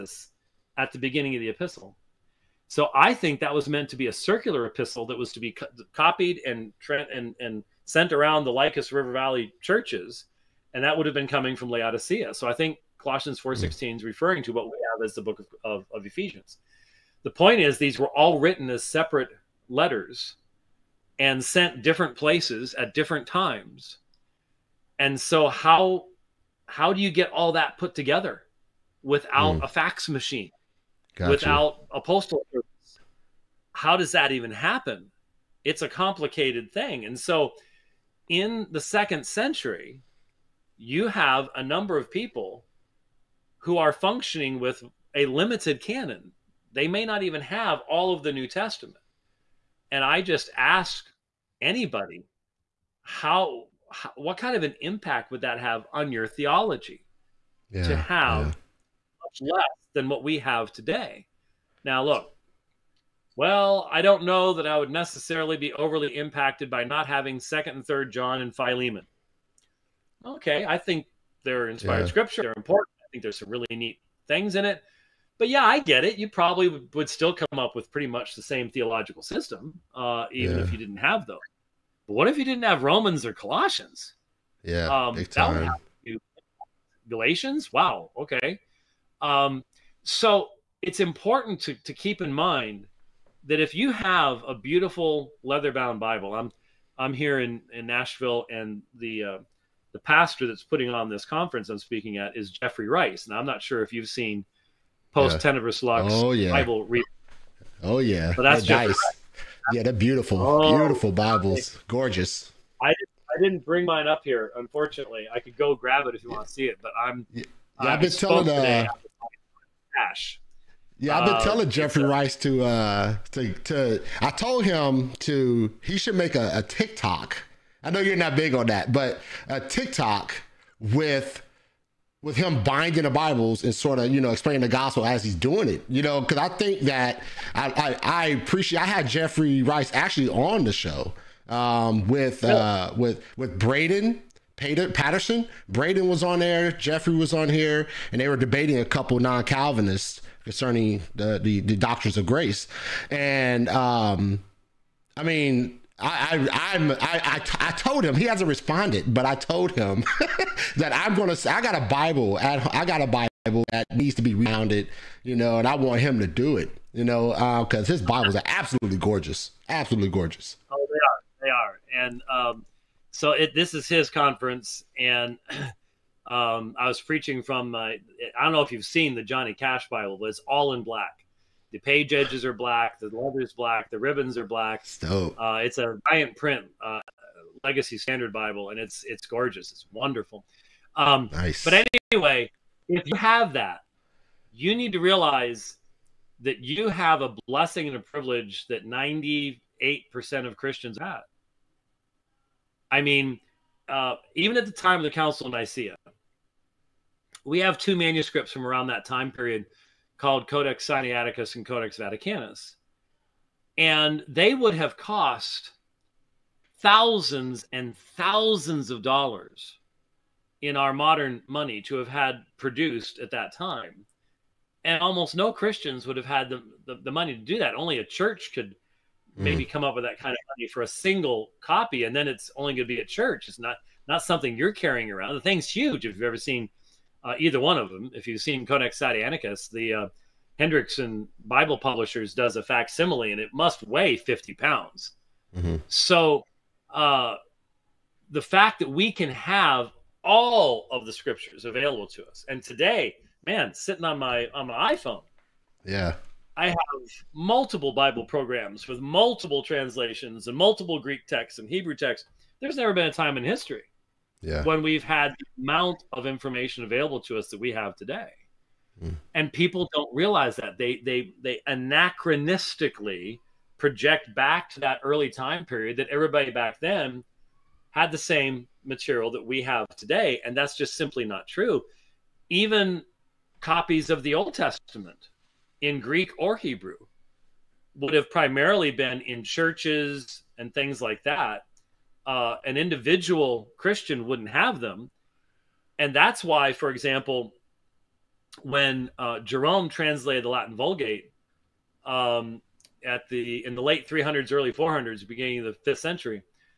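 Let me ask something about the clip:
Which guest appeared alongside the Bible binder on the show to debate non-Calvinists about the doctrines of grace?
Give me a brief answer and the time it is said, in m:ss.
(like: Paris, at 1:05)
Braden Patterson, at 2:23.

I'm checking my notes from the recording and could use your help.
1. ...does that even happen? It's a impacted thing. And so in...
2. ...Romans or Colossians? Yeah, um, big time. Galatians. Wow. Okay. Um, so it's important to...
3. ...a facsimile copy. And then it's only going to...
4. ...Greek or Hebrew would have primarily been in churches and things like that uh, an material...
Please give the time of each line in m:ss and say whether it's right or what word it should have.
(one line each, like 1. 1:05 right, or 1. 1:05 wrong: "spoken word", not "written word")
1. 0:33 wrong: "complicated", not "impacted"
2. 1:22 right
3. 3:50 wrong: "single", not "facsimile"
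4. 4:46 wrong: "individual", not "material".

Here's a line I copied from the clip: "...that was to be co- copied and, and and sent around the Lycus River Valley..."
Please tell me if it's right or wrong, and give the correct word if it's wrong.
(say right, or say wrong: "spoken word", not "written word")
right.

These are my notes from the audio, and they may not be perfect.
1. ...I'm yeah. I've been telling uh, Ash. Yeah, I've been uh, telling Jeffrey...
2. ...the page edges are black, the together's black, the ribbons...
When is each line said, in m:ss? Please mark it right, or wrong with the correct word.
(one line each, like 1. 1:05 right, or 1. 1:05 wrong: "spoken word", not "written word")
1. 1:57 right
2. 3:01 wrong: "leather", not "together".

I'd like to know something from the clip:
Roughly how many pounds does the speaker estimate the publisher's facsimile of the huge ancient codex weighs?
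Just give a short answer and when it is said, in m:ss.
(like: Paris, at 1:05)
50, at 4:04.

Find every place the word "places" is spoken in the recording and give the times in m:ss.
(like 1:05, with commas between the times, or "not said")
0:22.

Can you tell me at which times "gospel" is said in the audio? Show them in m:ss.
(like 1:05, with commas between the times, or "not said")
2:14.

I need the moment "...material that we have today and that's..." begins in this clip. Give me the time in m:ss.
4:38.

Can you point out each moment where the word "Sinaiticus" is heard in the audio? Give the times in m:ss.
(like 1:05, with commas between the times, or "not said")
3:30, 3:58.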